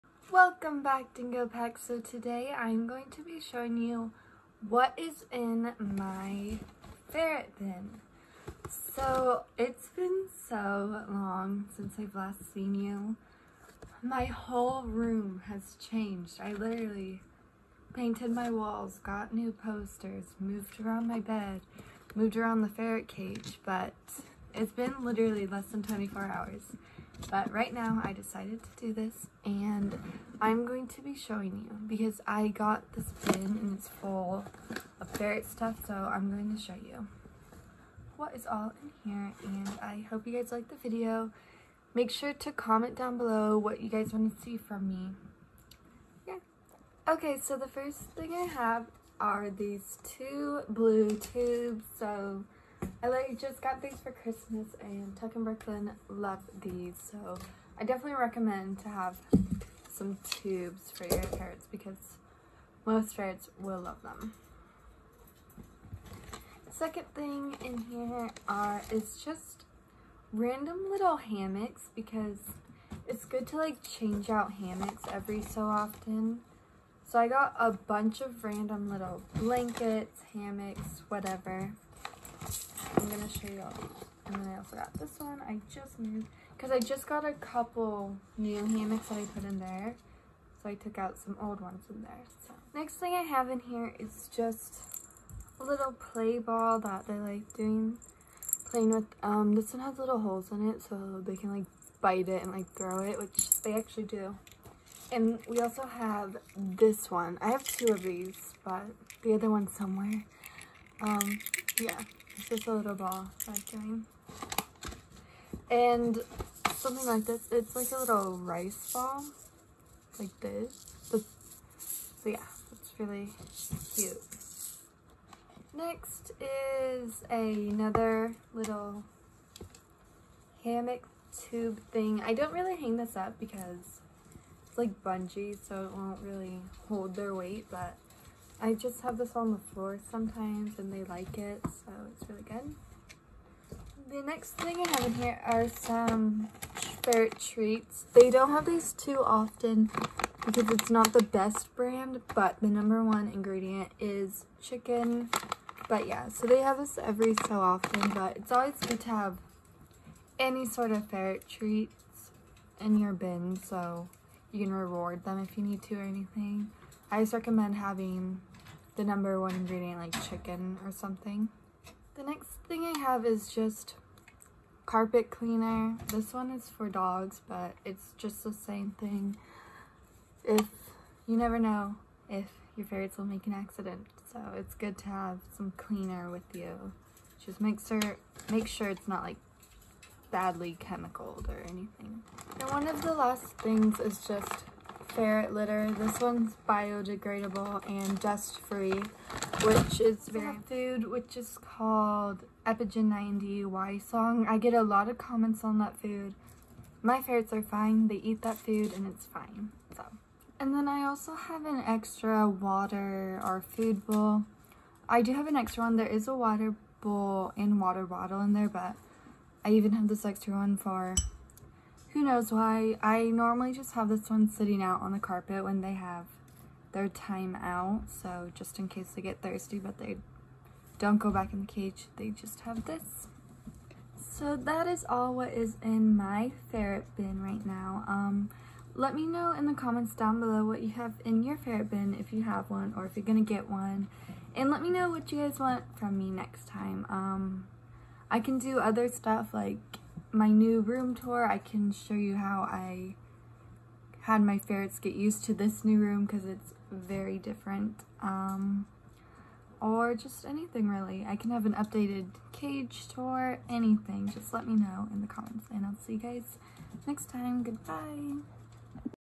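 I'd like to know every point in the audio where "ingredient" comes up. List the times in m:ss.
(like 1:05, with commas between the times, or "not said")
2:33, 2:49.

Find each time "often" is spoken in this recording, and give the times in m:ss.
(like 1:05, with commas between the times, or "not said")
1:15, 2:29, 2:37.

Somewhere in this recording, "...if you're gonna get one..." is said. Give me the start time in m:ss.
4:03.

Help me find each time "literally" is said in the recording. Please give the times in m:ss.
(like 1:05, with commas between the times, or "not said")
0:16, 0:25.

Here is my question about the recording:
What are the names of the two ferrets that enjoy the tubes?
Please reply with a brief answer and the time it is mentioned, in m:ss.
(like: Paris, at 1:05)
Tuck and Brooklyn, at 0:55.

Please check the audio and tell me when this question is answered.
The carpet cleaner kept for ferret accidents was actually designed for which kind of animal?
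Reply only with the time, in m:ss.
2:56.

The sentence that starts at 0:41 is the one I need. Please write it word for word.
Make sure to comment down below what you guys want to see from me.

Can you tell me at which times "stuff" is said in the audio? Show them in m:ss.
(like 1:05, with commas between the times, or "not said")
0:35, 4:09.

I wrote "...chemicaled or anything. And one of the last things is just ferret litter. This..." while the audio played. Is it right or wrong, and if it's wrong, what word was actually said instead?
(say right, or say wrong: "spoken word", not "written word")
right.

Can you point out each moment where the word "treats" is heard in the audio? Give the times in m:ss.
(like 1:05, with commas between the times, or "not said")
2:27, 2:41.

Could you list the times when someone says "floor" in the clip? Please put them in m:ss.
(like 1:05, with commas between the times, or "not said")
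2:19.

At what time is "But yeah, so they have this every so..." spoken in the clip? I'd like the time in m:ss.
2:35.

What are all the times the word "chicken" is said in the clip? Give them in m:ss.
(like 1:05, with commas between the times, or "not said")
2:34, 2:50.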